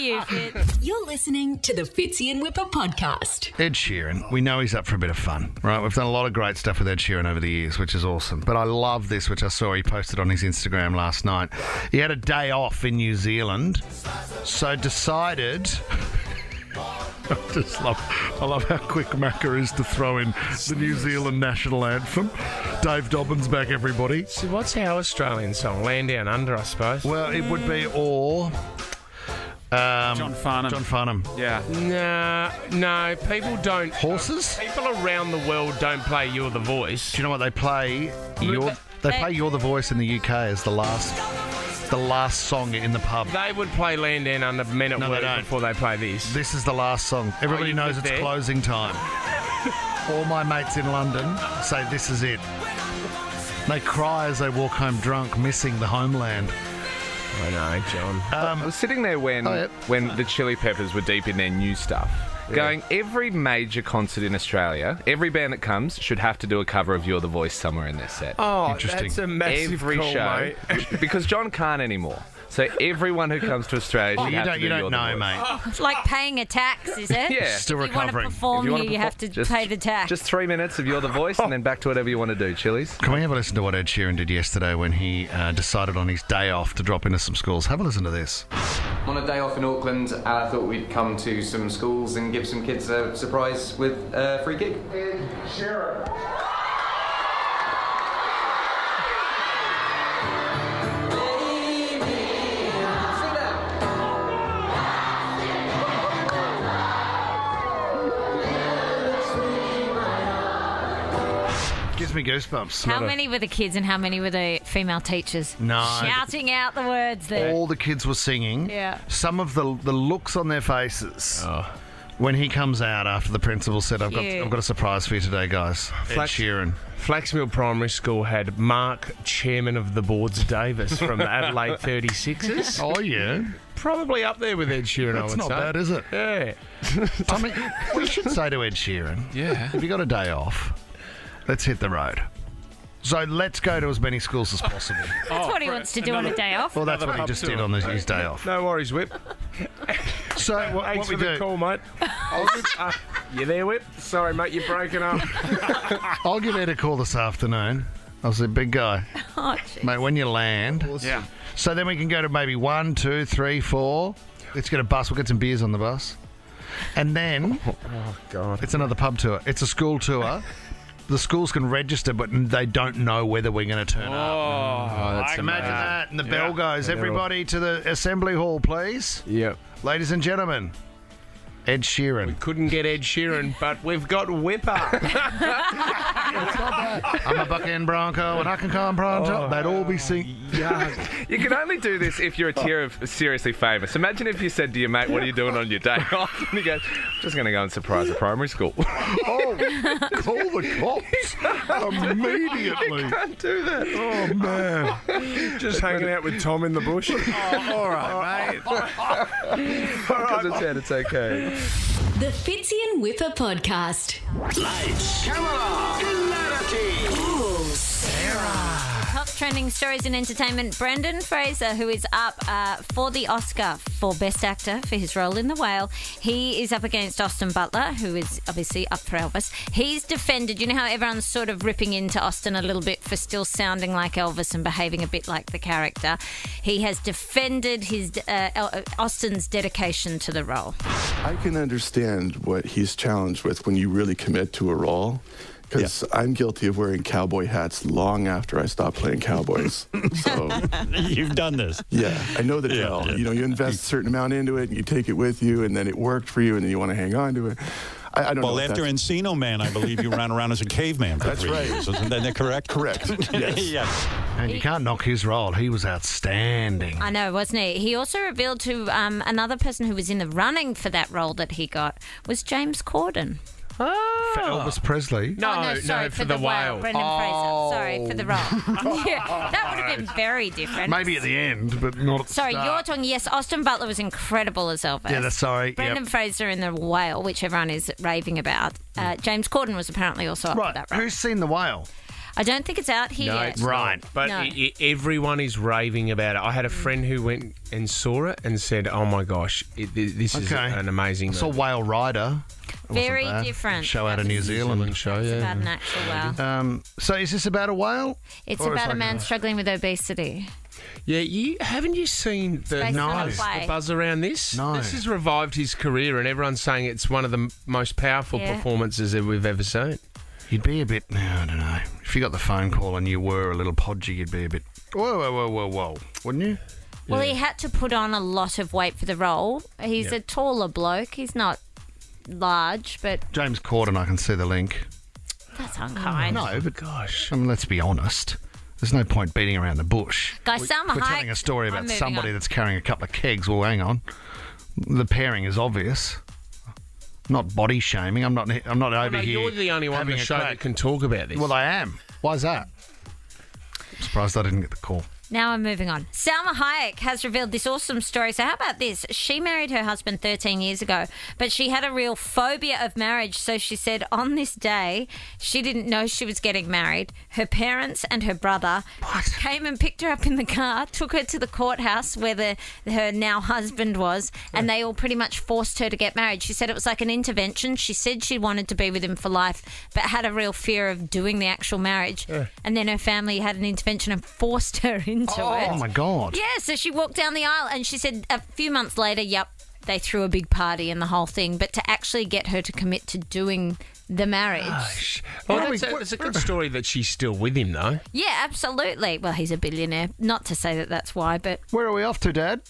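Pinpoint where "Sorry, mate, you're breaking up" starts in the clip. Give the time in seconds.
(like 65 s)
153 s.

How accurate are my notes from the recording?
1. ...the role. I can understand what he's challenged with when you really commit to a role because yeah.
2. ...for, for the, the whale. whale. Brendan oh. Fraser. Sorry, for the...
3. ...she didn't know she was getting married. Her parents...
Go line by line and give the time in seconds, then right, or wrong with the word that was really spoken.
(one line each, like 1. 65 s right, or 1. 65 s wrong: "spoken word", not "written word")
1. 240 s right
2. 276 s right
3. 365 s right.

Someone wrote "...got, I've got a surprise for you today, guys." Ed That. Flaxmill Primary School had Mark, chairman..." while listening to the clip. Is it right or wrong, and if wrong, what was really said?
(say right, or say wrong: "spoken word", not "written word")
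wrong: "Sheeran", not "That".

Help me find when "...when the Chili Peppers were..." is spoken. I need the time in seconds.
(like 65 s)
59 s.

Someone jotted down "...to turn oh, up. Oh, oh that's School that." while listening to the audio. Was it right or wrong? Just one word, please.
wrong.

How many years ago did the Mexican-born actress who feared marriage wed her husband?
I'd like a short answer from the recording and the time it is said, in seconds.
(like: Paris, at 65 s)
13, at 360 s.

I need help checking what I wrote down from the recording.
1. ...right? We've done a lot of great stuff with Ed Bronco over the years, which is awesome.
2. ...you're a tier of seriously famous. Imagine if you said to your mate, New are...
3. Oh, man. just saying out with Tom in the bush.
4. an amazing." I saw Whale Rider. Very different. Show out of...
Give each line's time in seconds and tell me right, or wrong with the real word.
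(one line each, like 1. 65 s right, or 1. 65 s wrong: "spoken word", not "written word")
1. 5 s wrong: "Sheeran", not "Bronco"
2. 192 s wrong: "What", not "New"
3. 203 s wrong: "hanging", not "saying"
4. 300 s right.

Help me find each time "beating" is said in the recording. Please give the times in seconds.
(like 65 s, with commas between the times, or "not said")
339 s.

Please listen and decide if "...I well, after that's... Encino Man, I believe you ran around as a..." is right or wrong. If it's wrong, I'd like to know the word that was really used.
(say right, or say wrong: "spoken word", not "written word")
right.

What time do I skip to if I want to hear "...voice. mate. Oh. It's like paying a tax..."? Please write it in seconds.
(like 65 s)
75 s.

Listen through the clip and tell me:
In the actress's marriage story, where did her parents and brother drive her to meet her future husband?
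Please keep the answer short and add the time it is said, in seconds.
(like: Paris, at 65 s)
The courthouse, at 371 s.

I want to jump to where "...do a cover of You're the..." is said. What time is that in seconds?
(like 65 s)
66 s.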